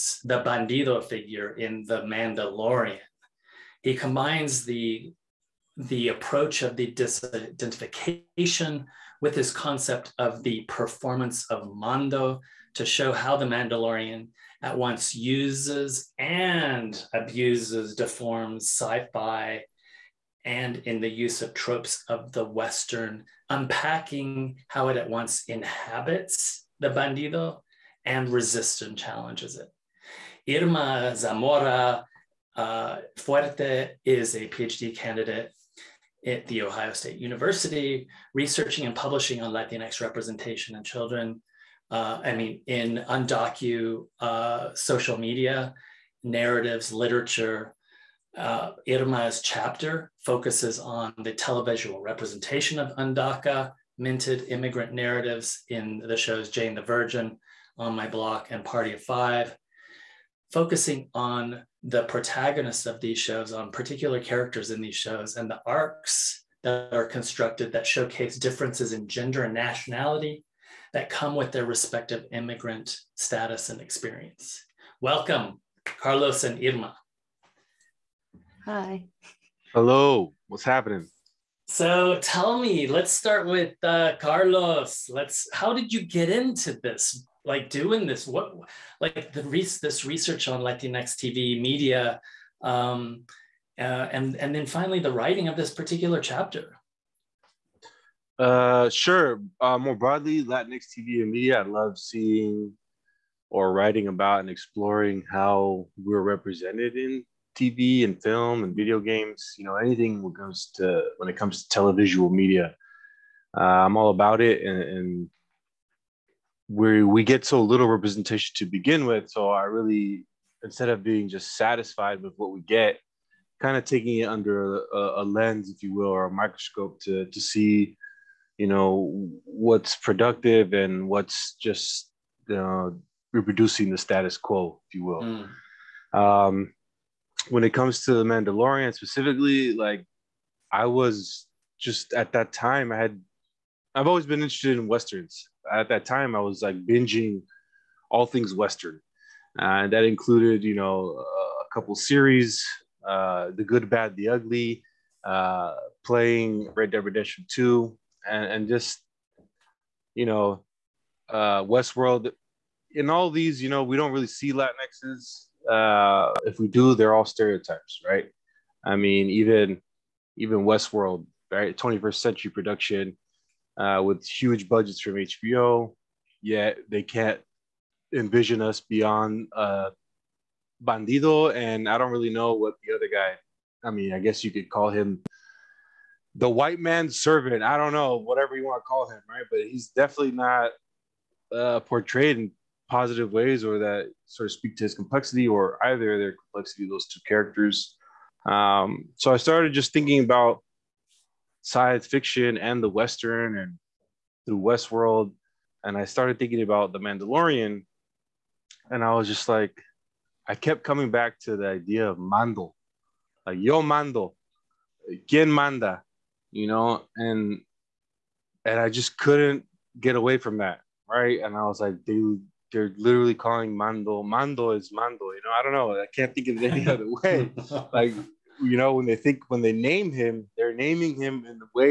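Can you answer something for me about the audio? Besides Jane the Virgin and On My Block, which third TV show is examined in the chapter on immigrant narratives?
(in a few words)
Party of Five.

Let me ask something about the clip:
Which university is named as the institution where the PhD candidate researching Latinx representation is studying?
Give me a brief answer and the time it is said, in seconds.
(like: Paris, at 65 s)
The Ohio State University, at 36 s.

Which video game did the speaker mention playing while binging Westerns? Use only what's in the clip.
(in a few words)
Red Dead Redemption Two.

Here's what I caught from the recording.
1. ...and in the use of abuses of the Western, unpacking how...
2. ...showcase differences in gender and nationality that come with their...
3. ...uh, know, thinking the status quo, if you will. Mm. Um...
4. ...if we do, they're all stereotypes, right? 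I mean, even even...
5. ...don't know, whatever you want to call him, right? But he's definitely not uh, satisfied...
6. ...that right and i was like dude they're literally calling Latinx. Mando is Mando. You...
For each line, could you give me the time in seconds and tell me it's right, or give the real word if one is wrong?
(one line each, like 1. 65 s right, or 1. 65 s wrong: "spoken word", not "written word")
1. 20 s wrong: "tropes", not "abuses"
2. 67 s right
3. 132 s wrong: "reproducing", not "thinking"
4. 166 s right
5. 187 s wrong: "portrayed", not "satisfied"
6. 220 s wrong: "Mando", not "Latinx".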